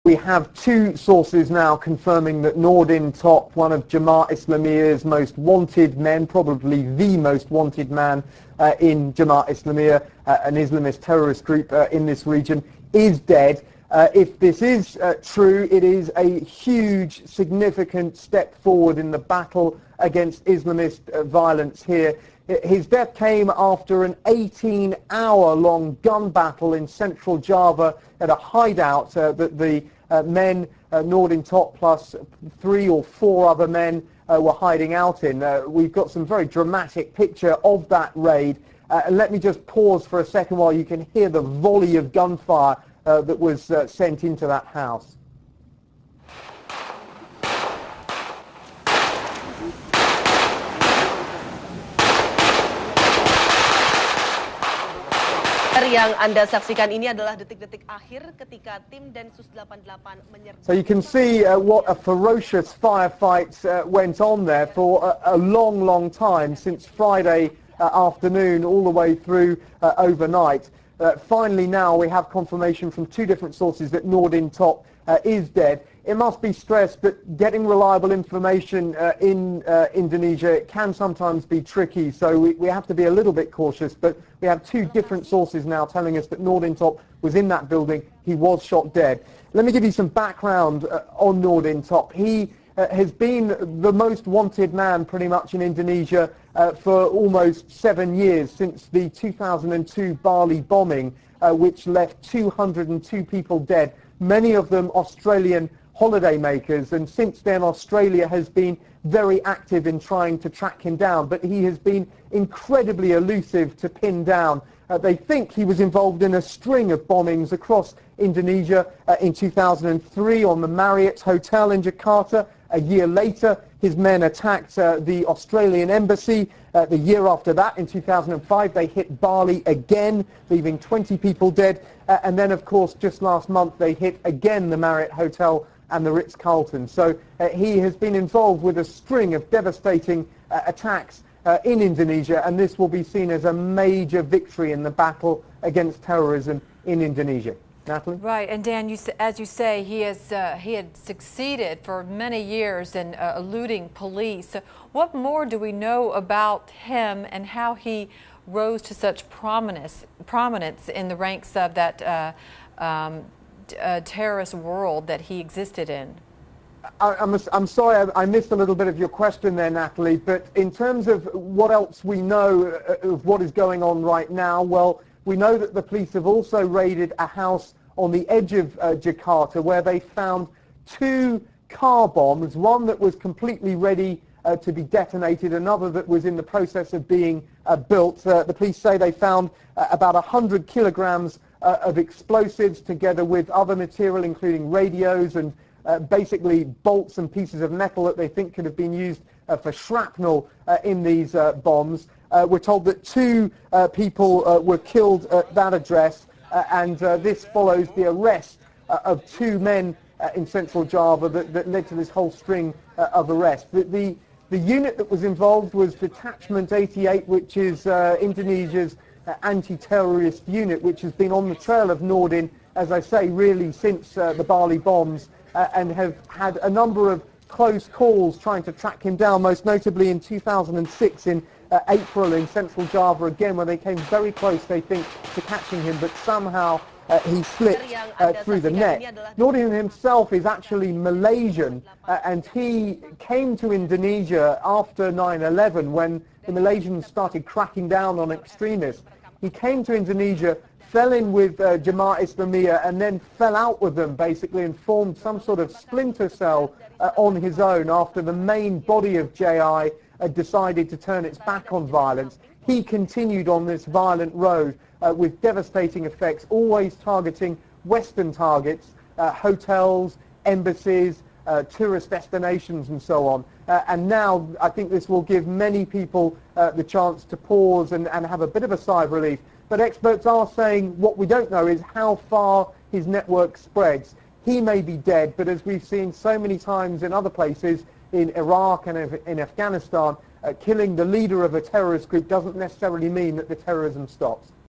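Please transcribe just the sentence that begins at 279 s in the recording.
But experts are saying what we don't know is how far his network spreads.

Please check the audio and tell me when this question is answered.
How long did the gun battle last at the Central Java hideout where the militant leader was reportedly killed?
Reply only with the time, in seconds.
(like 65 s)
24 s.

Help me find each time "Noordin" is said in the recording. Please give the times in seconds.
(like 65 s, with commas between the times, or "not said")
2 s, 31 s, 74 s, 86 s, 91 s, 222 s, 239 s.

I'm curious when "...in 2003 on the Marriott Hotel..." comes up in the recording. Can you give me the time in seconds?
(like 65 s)
119 s.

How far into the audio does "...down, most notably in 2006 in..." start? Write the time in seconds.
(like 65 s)
229 s.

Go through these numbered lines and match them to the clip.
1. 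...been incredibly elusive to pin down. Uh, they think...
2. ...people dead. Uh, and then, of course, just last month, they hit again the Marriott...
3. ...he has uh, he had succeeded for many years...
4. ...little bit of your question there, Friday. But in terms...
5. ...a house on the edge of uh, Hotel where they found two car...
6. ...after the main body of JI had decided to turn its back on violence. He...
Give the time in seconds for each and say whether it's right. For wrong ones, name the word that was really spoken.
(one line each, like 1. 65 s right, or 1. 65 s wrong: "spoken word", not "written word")
1. 111 s right
2. 131 s right
3. 149 s right
4. 168 s wrong: "Natalie", not "Friday"
5. 177 s wrong: "Jakarta", not "Hotel"
6. 257 s right.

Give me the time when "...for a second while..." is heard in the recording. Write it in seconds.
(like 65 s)
40 s.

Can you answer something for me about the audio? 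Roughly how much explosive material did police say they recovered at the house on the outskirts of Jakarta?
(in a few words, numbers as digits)
100 kilograms.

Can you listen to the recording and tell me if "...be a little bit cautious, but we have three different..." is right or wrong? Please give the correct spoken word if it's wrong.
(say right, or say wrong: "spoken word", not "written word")
wrong: "two", not "three".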